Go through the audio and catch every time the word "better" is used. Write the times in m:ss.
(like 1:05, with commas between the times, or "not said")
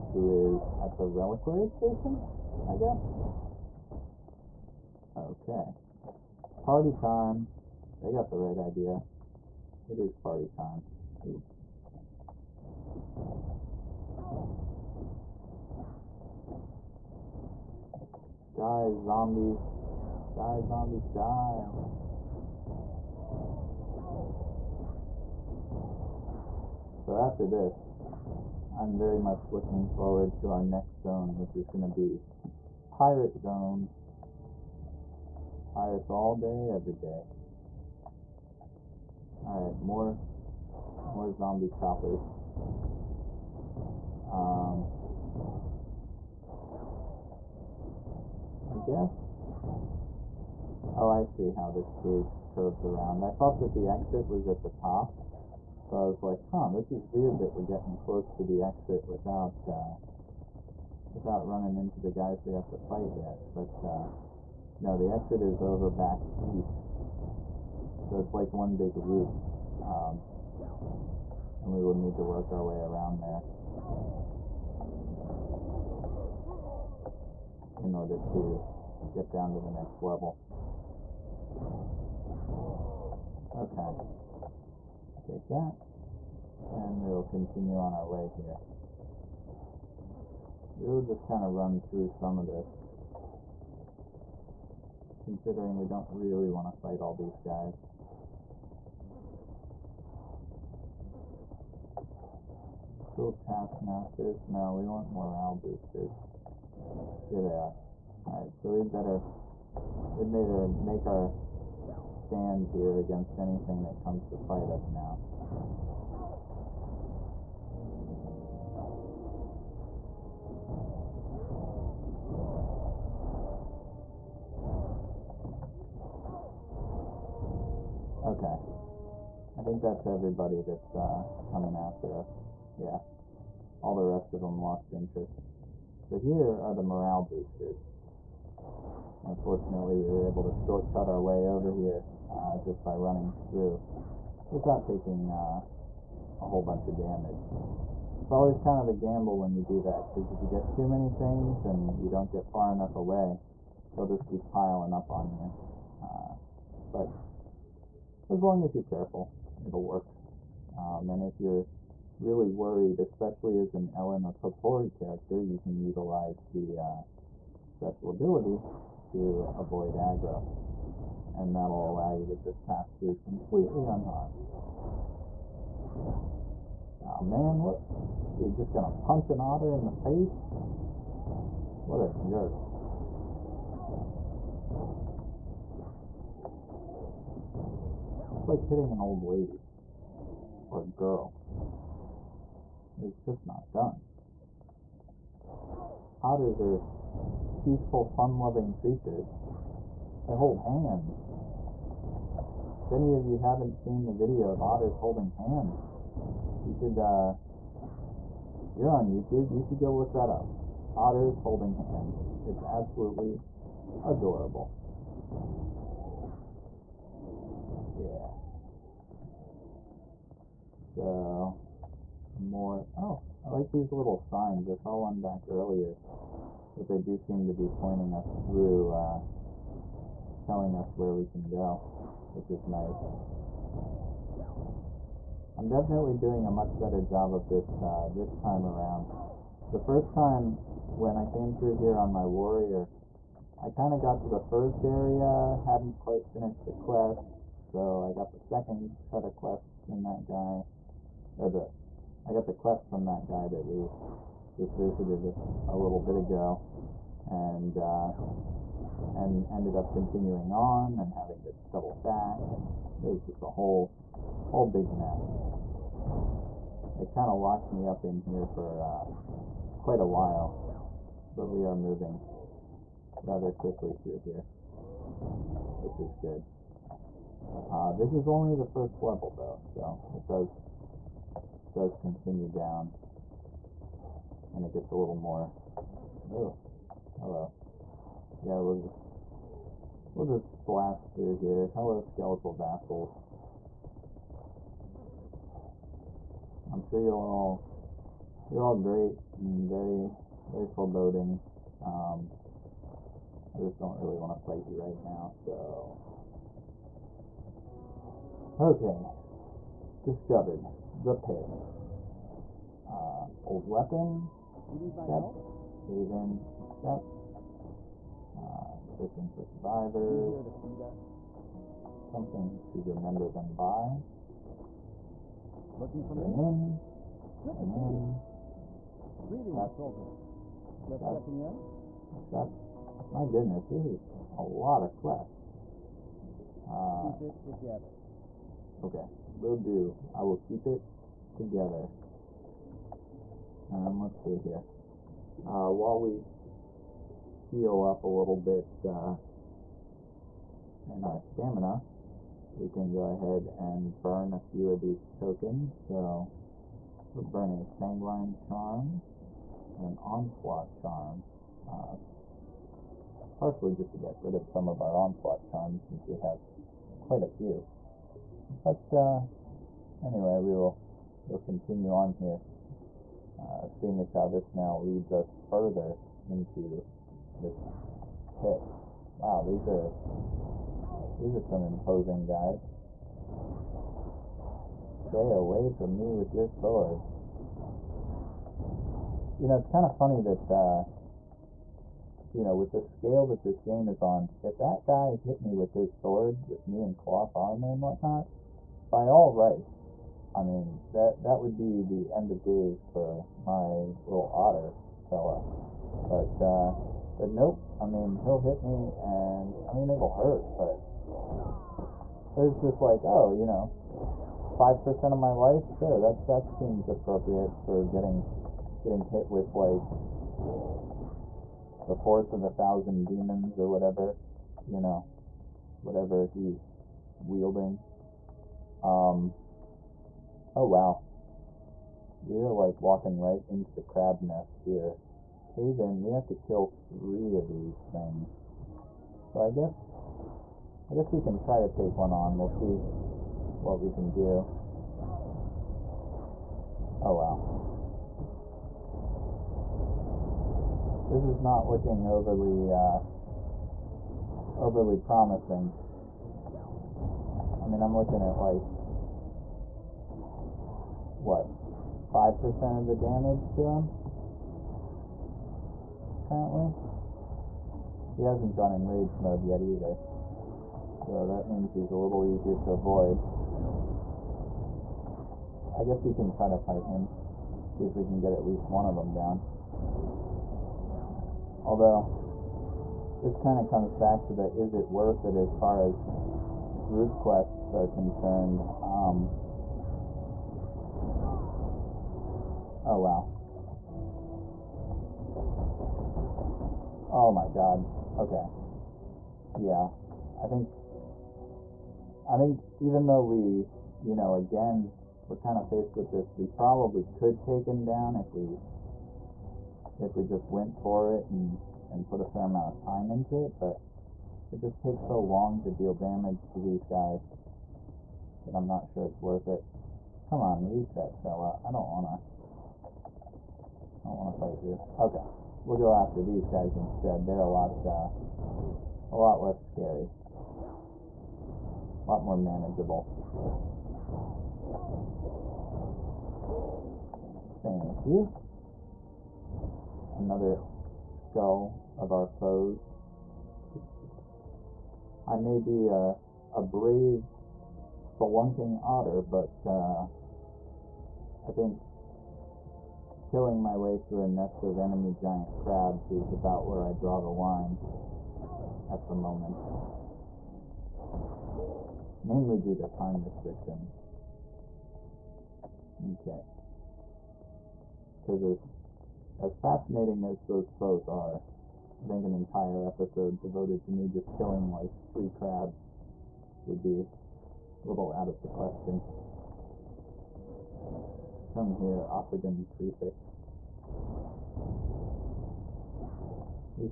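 1:48, 3:56.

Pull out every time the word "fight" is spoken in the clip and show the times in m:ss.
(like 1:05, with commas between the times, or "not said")
1:02, 1:36, 1:54, 5:04, 7:56, 8:44.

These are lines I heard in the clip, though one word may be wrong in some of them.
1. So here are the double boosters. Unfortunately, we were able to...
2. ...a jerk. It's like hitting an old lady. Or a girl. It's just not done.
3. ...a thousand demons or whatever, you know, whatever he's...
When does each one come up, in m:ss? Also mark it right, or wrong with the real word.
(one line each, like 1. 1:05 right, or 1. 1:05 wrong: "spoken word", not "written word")
1. 2:16 wrong: "morale", not "double"
2. 3:02 right
3. 7:02 right.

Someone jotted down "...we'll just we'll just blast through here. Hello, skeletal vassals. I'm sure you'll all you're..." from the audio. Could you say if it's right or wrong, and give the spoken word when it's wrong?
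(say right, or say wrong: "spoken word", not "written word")
right.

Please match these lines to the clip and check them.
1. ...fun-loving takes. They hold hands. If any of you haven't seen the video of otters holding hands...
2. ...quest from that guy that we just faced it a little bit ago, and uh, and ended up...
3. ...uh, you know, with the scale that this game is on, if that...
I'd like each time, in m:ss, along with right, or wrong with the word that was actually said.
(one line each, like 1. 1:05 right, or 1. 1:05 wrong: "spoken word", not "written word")
1. 3:18 wrong: "creatures", not "takes"
2. 4:12 wrong: "visited", not "faced"
3. 6:30 right.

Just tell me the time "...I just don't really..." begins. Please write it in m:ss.
5:03.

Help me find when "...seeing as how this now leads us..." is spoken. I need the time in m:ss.
6:13.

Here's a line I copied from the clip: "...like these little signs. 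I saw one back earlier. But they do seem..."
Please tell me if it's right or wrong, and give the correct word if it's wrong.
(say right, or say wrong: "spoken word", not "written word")
right.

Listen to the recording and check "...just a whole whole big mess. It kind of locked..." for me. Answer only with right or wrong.
right.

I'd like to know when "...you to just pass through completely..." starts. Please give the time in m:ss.
2:52.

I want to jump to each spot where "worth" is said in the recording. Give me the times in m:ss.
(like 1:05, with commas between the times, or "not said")
8:04, 8:39.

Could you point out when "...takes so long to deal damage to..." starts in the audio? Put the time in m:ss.
8:34.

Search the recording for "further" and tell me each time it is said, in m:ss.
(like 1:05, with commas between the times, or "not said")
6:15.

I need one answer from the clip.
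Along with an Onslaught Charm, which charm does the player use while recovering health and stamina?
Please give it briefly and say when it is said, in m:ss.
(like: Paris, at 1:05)
Sanguine Charm, at 5:57.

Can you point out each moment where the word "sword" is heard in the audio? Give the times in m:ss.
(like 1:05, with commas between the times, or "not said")
6:26, 6:35.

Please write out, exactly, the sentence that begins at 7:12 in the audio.
We're, like, walking right into the crab nest here.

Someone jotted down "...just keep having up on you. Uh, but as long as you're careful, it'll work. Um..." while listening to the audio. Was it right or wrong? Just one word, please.
wrong.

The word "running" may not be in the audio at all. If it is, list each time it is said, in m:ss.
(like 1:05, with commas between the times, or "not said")
1:01, 2:22.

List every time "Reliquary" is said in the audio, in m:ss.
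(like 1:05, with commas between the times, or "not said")
0:01.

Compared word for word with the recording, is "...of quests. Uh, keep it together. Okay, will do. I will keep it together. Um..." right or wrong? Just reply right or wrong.
right.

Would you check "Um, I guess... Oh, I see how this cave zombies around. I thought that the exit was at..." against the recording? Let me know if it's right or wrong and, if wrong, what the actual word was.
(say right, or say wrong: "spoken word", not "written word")
wrong: "curves", not "zombies".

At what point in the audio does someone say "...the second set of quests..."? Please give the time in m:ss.
4:08.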